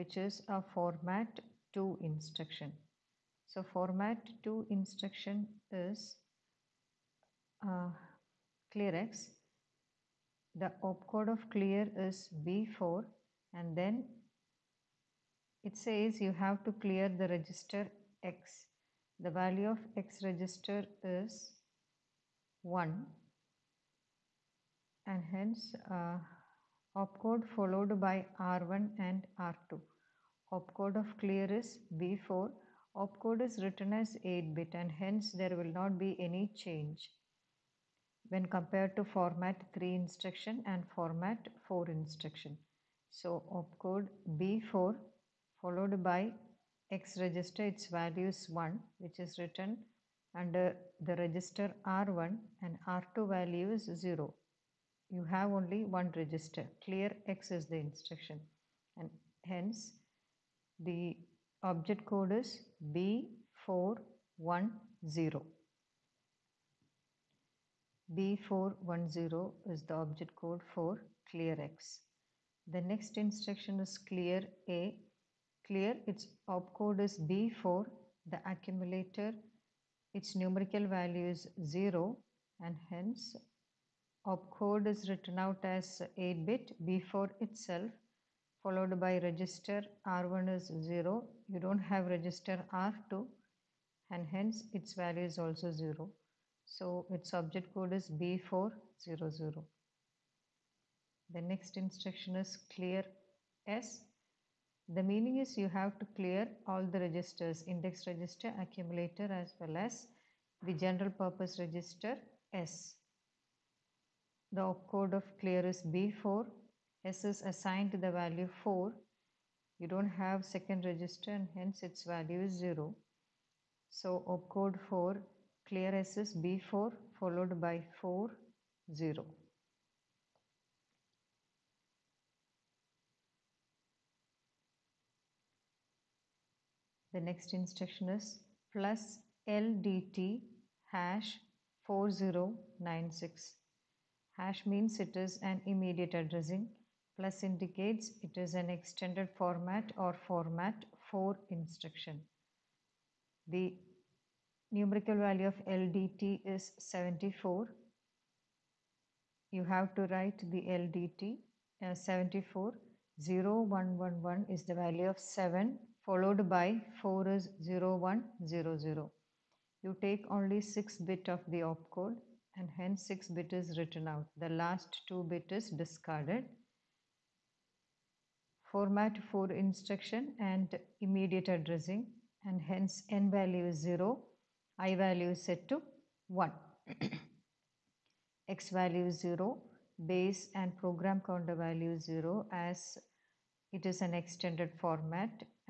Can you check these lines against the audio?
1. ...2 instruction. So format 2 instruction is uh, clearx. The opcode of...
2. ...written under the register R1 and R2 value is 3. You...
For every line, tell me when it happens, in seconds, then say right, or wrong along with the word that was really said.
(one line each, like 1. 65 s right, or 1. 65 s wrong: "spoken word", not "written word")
1. 1 s right
2. 49 s wrong: "0", not "3".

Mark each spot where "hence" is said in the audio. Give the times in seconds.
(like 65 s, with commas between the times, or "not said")
25 s, 34 s, 59 s, 82 s, 94 s, 121 s, 172 s, 182 s.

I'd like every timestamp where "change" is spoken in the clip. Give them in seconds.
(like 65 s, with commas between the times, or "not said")
36 s.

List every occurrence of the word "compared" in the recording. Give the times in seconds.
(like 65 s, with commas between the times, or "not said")
38 s.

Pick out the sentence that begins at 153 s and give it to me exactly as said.
The numerical value of LDT is 74.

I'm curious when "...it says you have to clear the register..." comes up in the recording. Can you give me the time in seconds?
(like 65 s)
15 s.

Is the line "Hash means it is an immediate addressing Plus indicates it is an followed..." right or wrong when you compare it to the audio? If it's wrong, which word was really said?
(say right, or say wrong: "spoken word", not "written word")
wrong: "extended", not "followed".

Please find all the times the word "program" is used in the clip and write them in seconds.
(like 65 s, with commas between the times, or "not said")
190 s.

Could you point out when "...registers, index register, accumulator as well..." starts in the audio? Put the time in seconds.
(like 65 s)
107 s.